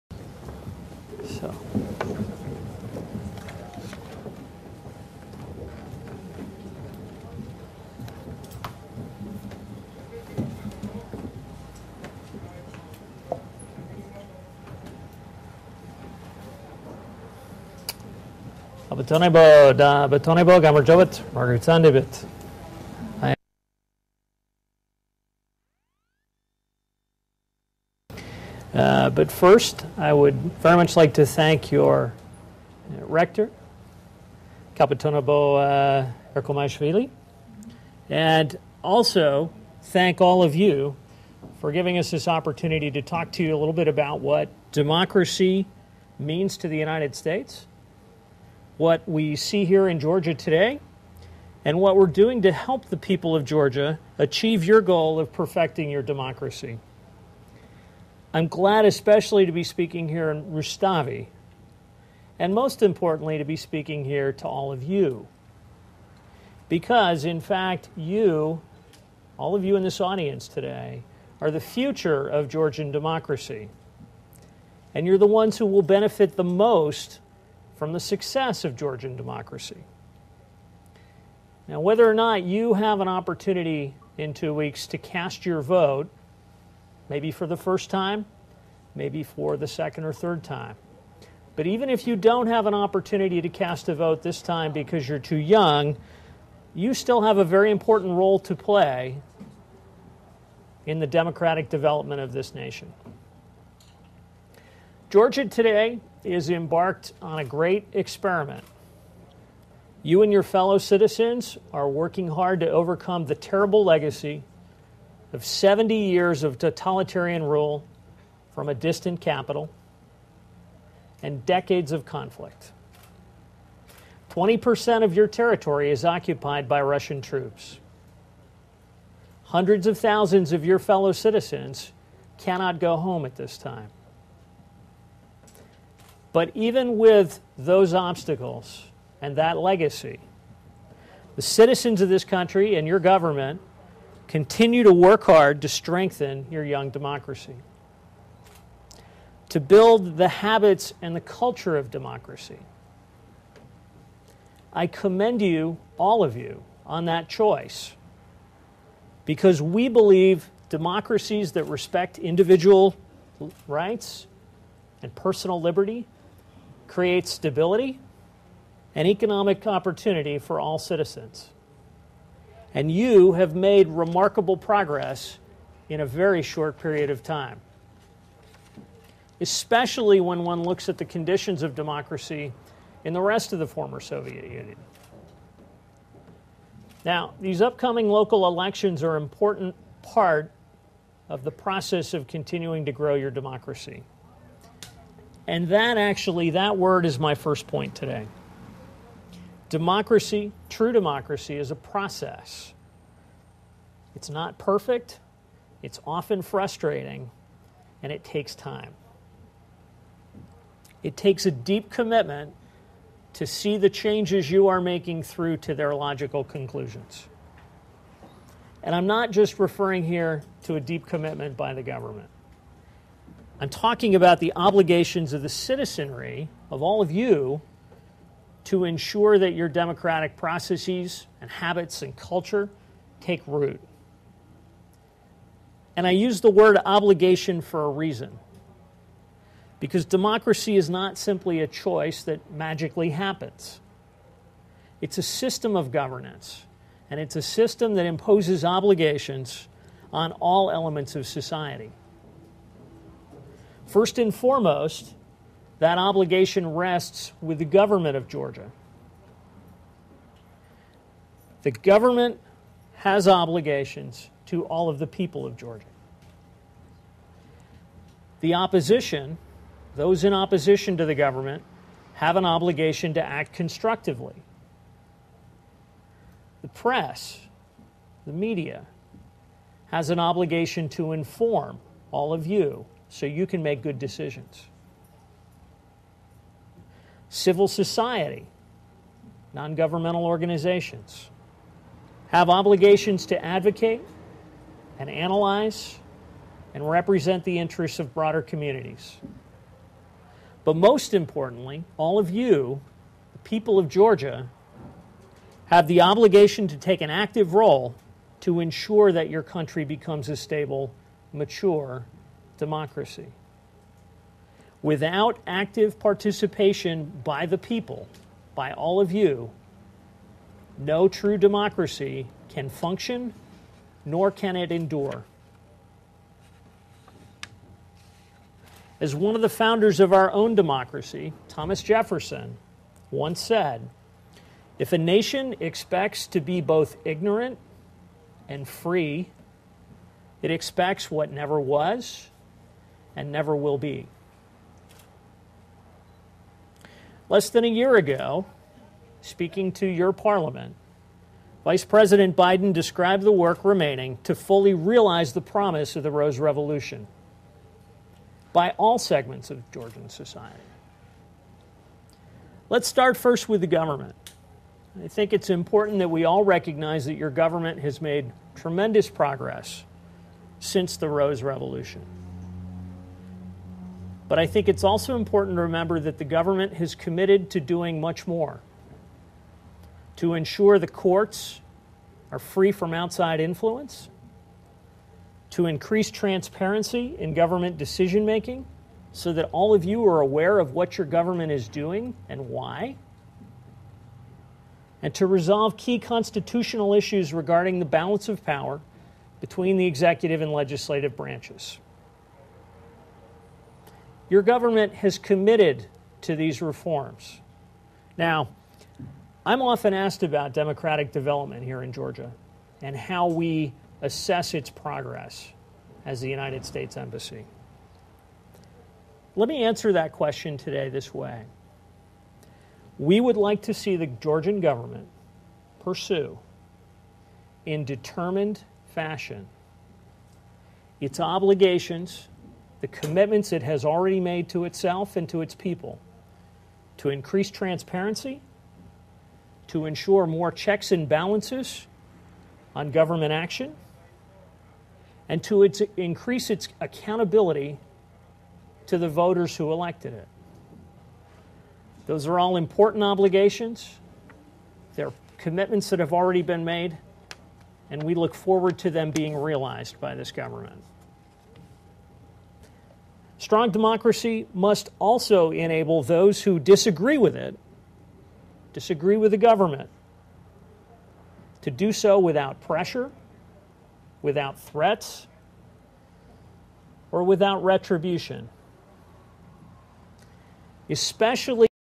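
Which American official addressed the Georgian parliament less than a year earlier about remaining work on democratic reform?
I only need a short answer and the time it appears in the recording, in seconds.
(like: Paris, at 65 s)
Vice President Biden, at 351 s.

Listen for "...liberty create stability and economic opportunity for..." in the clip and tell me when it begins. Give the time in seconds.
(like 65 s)
165 s.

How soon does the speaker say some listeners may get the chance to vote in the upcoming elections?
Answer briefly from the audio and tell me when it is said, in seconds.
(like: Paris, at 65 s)
two weeks, at 84 s.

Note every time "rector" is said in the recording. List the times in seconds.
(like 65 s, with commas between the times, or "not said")
33 s.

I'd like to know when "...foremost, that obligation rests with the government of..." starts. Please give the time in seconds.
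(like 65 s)
254 s.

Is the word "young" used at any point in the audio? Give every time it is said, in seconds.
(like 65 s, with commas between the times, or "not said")
95 s, 146 s.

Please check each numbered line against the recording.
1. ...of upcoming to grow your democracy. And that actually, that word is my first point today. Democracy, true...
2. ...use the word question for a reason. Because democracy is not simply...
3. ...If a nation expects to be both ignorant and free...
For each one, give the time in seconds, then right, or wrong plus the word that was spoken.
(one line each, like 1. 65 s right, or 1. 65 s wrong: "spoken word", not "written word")
1. 192 s wrong: "continuing", not "upcoming"
2. 236 s wrong: "obligation", not "question"
3. 334 s right.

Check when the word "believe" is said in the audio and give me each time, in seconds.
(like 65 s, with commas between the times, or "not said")
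159 s.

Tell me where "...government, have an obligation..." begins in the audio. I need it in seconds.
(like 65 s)
271 s.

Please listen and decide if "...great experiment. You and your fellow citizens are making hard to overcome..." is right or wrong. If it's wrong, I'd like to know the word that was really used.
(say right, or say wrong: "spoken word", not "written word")
wrong: "working", not "making".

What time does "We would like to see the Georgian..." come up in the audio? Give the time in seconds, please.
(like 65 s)
422 s.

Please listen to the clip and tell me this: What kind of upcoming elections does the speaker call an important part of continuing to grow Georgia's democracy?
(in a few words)
local elections.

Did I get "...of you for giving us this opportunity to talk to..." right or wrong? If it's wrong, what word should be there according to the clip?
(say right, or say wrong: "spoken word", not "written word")
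right.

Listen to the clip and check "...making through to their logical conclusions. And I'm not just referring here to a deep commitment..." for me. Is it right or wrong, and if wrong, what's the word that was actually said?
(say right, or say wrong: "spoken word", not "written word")
right.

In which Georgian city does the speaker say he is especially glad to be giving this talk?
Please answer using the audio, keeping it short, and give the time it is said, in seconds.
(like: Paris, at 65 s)
Rustavi, at 60 s.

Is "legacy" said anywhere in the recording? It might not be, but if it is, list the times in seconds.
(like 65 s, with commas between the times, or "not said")
113 s, 139 s.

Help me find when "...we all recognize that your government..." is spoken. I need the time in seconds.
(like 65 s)
366 s.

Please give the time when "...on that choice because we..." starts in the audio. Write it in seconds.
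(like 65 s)
156 s.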